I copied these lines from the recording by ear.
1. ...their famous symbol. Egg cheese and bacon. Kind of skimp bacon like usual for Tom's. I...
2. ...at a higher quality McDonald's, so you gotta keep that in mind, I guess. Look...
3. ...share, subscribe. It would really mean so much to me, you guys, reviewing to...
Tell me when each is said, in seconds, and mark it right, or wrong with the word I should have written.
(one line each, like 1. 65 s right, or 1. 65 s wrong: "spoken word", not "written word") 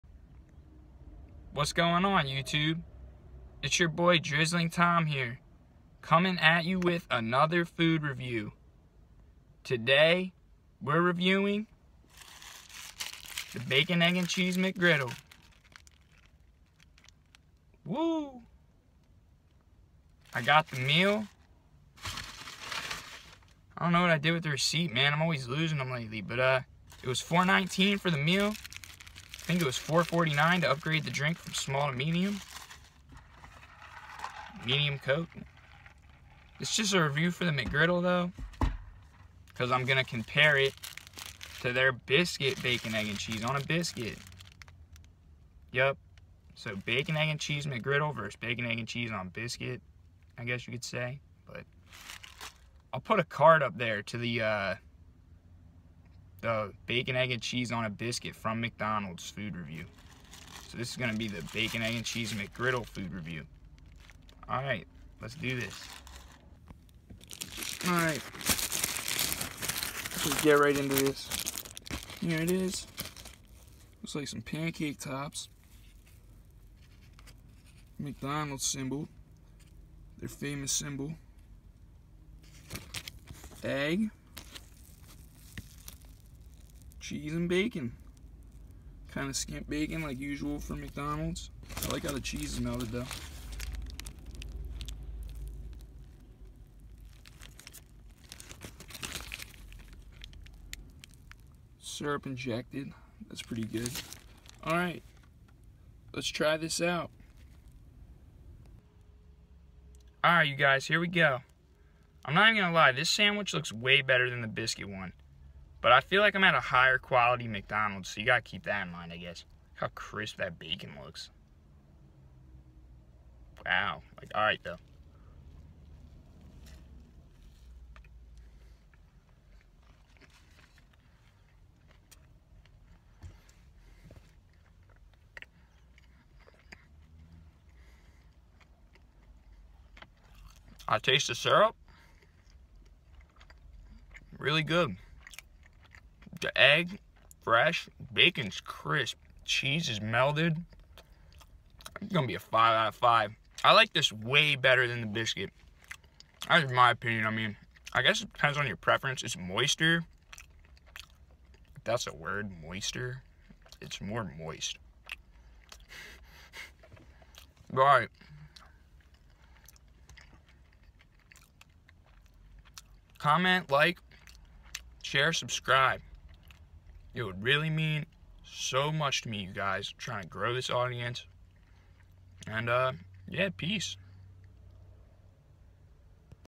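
1. 80 s wrong: "McDonald", not "Tom"
2. 116 s right
3. 175 s wrong: "trying", not "reviewing".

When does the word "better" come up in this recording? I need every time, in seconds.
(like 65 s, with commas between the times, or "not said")
114 s, 154 s.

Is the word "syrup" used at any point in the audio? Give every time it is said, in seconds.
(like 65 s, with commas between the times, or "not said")
101 s, 141 s.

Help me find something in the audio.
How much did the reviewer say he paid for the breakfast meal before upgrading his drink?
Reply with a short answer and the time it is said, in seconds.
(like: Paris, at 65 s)
$4.19, at 27 s.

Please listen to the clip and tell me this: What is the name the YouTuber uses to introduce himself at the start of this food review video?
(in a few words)
Drizzling Tom.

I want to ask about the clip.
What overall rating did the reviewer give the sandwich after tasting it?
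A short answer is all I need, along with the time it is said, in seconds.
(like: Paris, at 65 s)
5 out of 5, at 152 s.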